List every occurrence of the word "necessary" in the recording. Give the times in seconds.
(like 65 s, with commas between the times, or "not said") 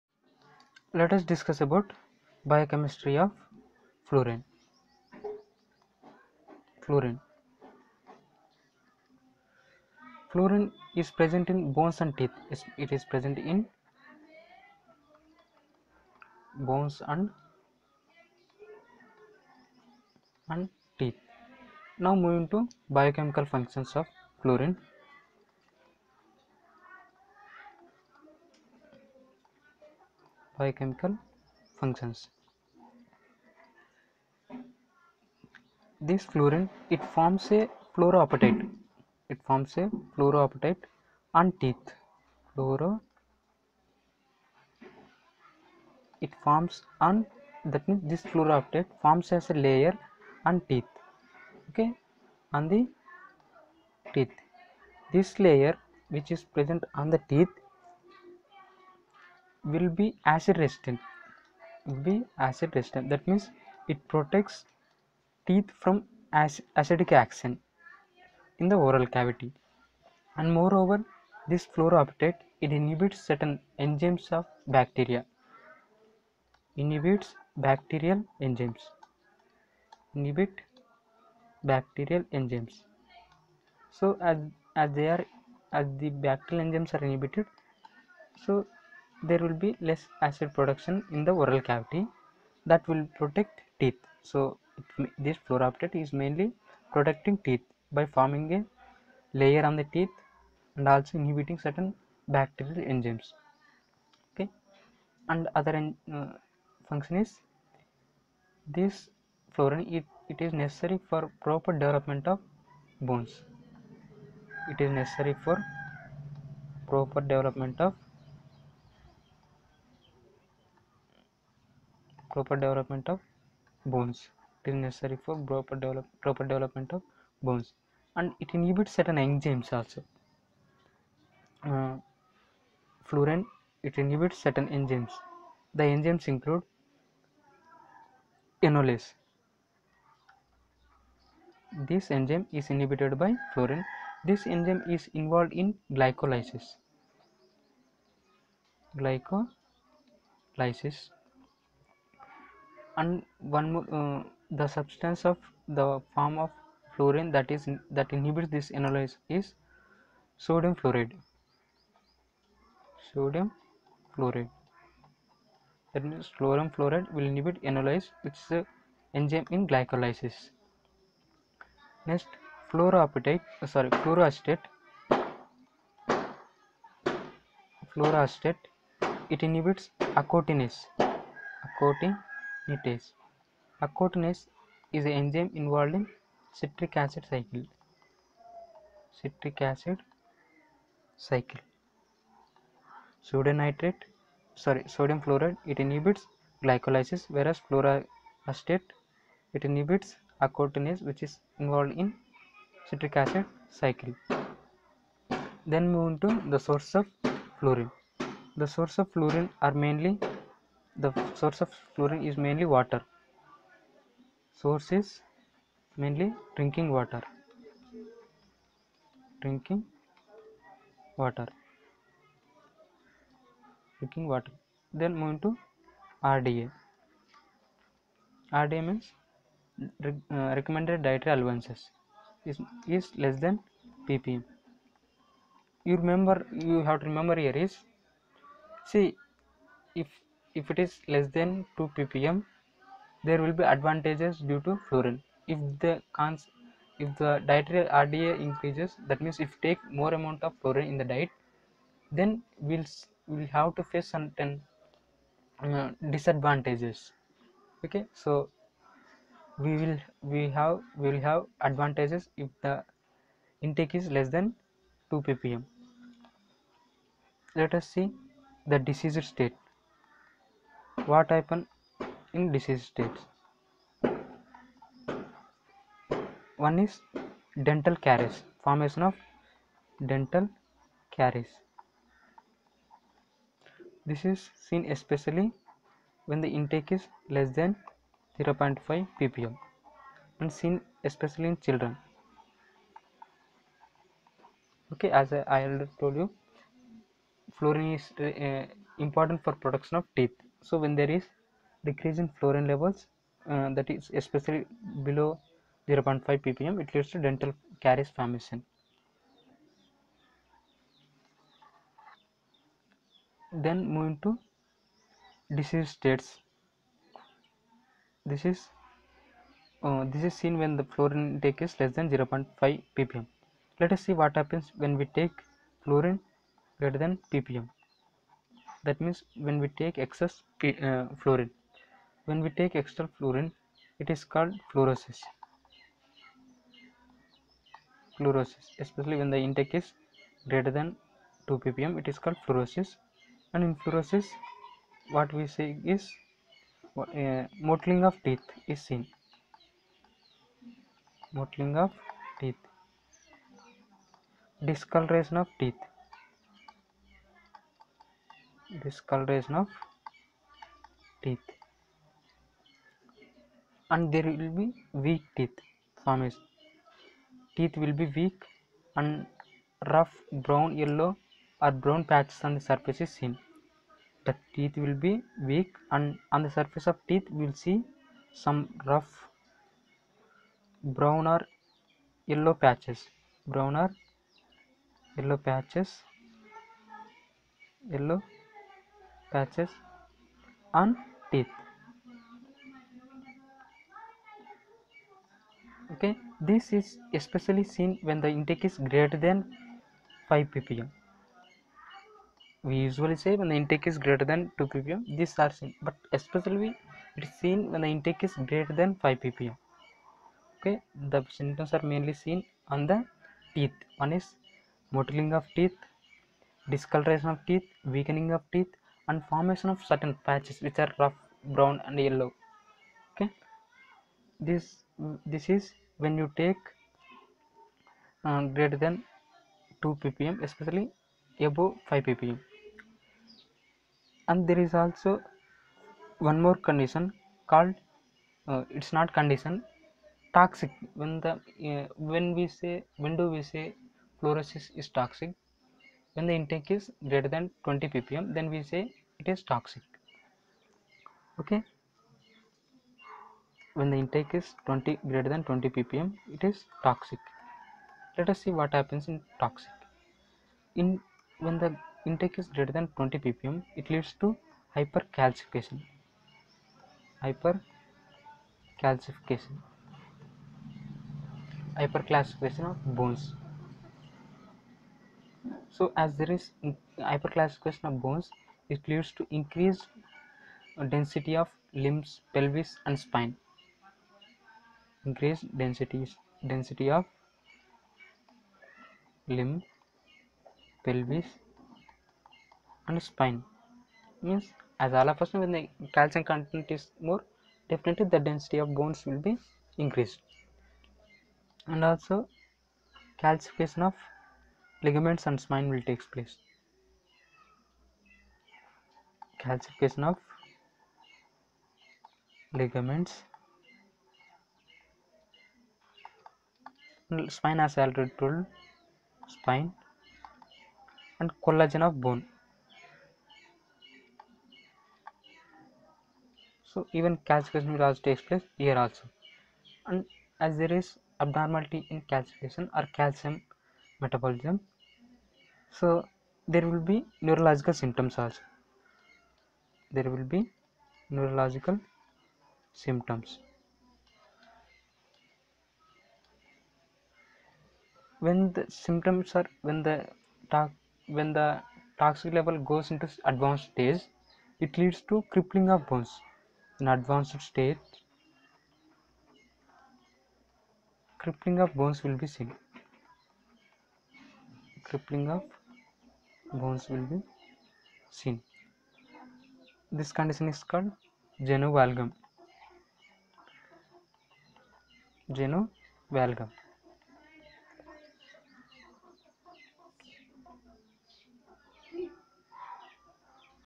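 110 s, 115 s, 124 s.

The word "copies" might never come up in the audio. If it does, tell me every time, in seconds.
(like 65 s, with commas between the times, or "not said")
not said.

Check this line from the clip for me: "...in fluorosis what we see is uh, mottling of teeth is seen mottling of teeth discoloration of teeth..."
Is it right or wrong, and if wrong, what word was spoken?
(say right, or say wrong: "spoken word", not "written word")
right.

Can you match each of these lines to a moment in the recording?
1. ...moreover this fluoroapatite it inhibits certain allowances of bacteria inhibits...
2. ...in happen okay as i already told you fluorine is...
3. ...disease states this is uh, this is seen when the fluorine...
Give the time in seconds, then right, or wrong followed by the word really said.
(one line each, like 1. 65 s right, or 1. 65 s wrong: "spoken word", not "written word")
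1. 70 s wrong: "enzymes", not "allowances"
2. 291 s wrong: "children", not "happen"
3. 315 s right.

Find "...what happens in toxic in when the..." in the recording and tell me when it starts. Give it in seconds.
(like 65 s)
458 s.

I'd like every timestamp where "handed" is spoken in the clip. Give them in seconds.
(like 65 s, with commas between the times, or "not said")
not said.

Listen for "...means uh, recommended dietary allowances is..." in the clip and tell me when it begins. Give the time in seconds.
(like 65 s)
228 s.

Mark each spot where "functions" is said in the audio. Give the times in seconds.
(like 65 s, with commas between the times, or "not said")
23 s, 31 s, 106 s.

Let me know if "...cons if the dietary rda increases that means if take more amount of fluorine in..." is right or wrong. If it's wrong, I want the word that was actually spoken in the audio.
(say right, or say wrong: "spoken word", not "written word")
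right.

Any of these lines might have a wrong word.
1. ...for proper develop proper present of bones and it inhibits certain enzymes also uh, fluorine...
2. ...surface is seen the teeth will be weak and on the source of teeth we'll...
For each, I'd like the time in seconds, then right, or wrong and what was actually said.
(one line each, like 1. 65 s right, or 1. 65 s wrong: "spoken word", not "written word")
1. 125 s wrong: "development", not "present"
2. 372 s wrong: "surface", not "source".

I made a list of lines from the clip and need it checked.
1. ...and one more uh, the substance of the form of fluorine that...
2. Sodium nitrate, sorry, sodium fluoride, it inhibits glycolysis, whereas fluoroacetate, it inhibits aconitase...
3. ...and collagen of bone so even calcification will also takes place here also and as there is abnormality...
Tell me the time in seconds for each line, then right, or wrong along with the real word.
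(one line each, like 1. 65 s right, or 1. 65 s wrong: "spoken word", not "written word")
1. 152 s right
2. 193 s right
3. 521 s right.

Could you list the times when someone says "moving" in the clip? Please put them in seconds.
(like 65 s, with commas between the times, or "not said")
22 s, 225 s, 313 s.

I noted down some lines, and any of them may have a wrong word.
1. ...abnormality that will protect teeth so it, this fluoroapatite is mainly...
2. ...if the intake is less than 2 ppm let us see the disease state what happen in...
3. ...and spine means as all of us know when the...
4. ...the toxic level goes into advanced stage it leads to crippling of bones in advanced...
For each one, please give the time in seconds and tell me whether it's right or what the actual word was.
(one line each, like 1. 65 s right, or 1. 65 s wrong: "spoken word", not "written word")
1. 91 s wrong: "cavity", not "abnormality"
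2. 262 s right
3. 492 s right
4. 551 s right.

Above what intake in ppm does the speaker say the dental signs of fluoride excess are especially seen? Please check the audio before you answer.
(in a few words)
5 ppm.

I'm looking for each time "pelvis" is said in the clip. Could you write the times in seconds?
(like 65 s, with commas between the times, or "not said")
482 s, 490 s.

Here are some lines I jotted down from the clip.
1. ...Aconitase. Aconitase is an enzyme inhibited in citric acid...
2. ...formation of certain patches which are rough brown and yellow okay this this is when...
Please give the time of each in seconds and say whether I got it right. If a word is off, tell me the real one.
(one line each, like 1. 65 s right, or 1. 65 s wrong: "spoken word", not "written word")
1. 182 s wrong: "involved", not "inhibited"
2. 419 s right.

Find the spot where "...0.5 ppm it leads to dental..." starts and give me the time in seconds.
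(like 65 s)
305 s.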